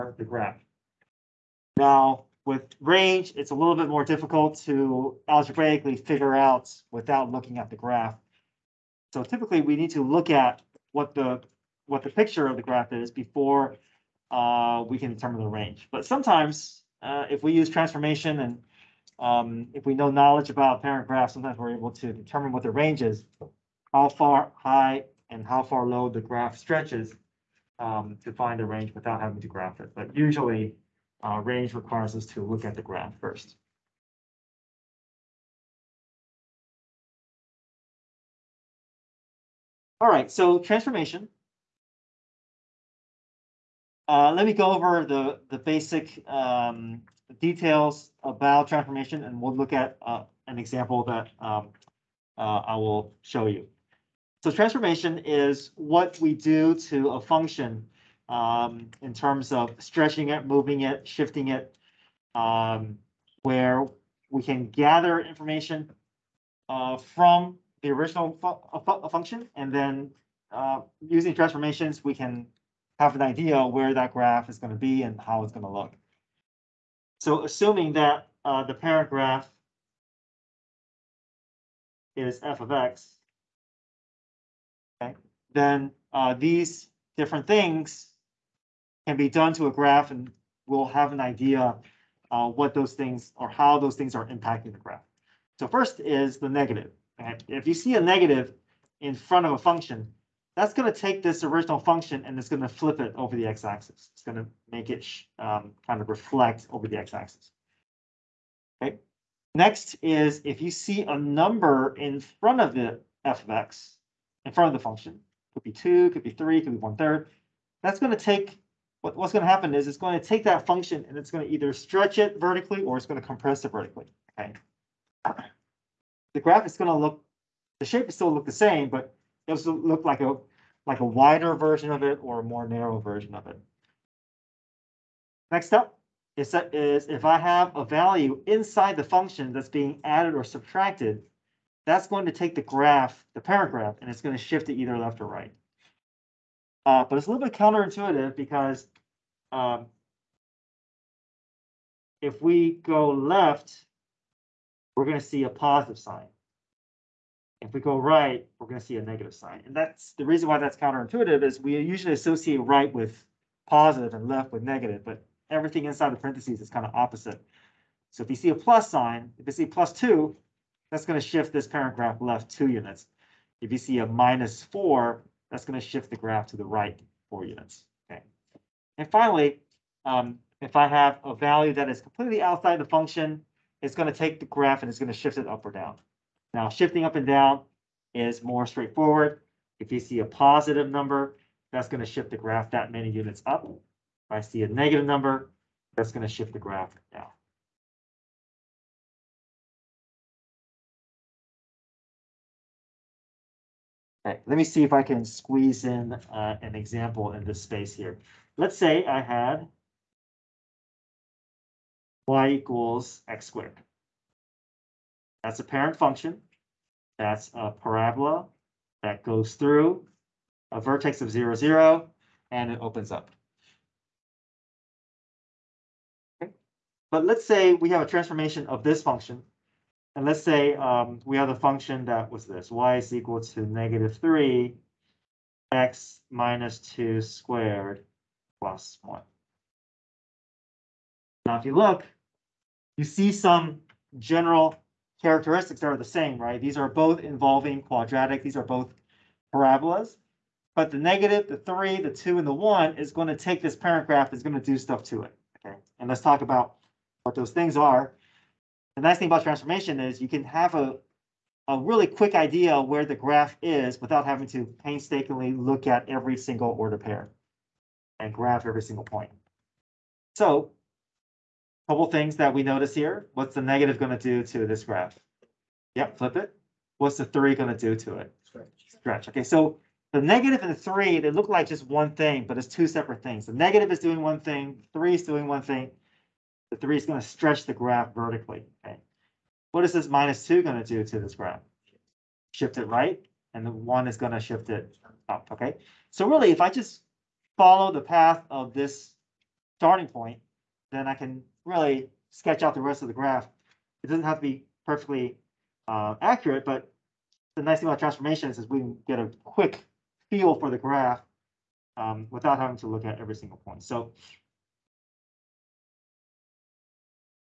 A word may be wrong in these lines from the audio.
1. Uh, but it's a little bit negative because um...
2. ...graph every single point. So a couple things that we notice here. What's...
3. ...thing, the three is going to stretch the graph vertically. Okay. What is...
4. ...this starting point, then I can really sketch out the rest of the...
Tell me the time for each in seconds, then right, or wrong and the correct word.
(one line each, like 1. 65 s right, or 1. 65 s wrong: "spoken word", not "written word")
1. 146 s wrong: "counterintuitive", not "negative"
2. 268 s right
3. 285 s right
4. 298 s right.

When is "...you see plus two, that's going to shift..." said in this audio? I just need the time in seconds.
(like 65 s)
169 s.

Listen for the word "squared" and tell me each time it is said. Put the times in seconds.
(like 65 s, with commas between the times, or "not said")
213 s, 237 s.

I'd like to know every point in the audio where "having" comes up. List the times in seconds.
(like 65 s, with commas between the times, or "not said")
29 s, 264 s, 312 s.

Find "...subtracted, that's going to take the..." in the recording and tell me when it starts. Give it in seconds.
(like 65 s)
140 s.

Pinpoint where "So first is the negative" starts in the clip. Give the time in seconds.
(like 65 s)
95 s.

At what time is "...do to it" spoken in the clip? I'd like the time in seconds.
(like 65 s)
277 s.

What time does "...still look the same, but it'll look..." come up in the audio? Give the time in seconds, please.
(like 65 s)
128 s.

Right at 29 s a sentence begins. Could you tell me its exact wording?
But usually uh, range requires us to look at the graph first.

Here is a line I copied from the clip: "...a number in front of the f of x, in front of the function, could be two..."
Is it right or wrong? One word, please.
right.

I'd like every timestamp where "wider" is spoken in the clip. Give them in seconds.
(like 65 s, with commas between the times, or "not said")
131 s.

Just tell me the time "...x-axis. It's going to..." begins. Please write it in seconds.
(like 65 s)
103 s.